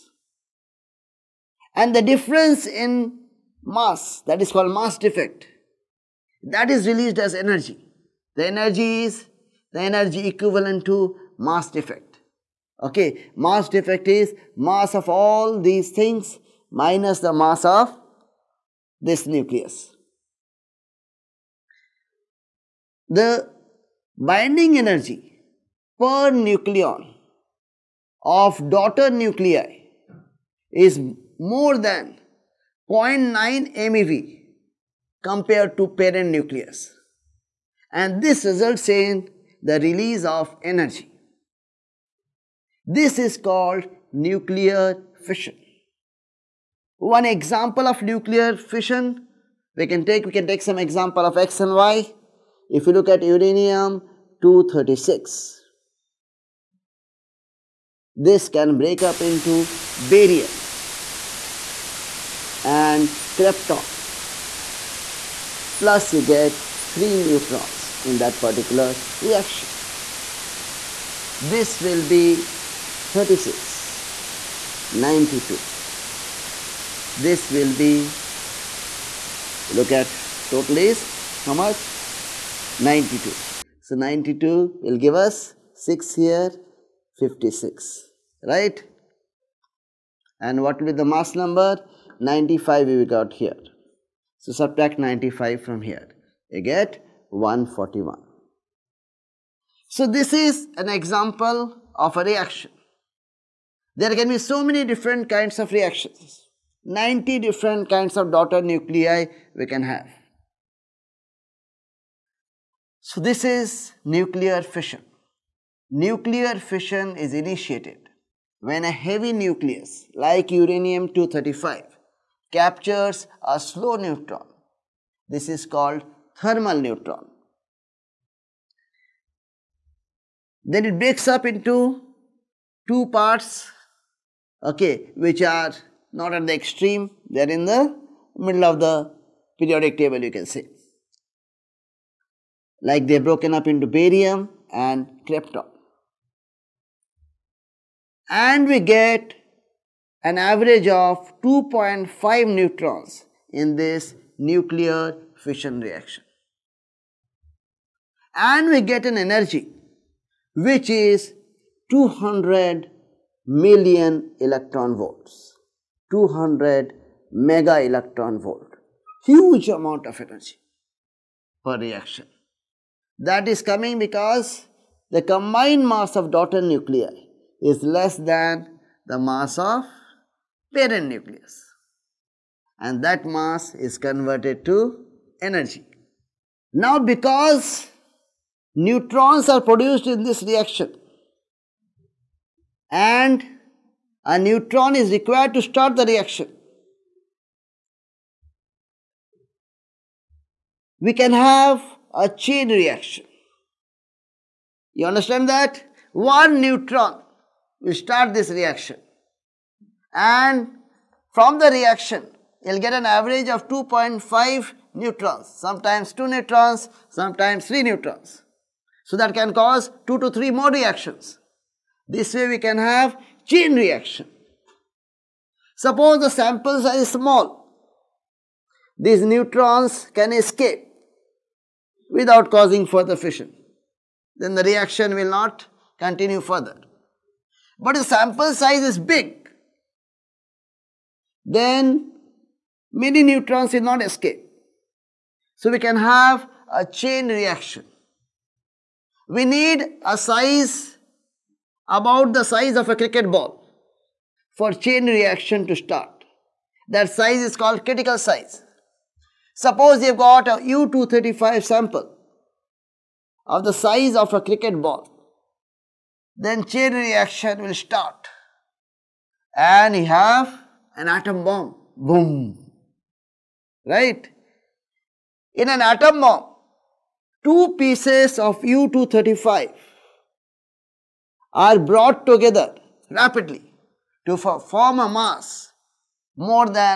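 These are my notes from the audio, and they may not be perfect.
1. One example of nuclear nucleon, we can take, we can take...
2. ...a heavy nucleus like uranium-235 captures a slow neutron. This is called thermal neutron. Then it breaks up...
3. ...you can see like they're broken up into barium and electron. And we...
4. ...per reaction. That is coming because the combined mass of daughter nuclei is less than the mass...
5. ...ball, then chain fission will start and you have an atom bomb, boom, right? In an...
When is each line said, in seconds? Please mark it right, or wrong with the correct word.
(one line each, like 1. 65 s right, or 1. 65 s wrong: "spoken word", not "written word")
1. 46 s wrong: "fission", not "nucleon"
2. 118 s right
3. 140 s wrong: "krypton", not "electron"
4. 171 s right
5. 264 s wrong: "reaction", not "fission".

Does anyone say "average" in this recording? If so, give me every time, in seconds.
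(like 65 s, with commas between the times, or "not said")
150 s, 213 s.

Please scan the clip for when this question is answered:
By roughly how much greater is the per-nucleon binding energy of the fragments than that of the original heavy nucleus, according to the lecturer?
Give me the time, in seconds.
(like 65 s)
32 s.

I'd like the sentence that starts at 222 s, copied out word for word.
This way we can have chain reaction.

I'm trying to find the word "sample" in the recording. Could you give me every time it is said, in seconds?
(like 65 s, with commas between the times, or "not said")
226 s, 238 s, 261 s.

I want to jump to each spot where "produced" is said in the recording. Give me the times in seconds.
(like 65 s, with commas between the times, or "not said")
189 s.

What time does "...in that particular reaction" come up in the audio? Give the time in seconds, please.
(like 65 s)
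68 s.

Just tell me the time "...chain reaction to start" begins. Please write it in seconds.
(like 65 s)
254 s.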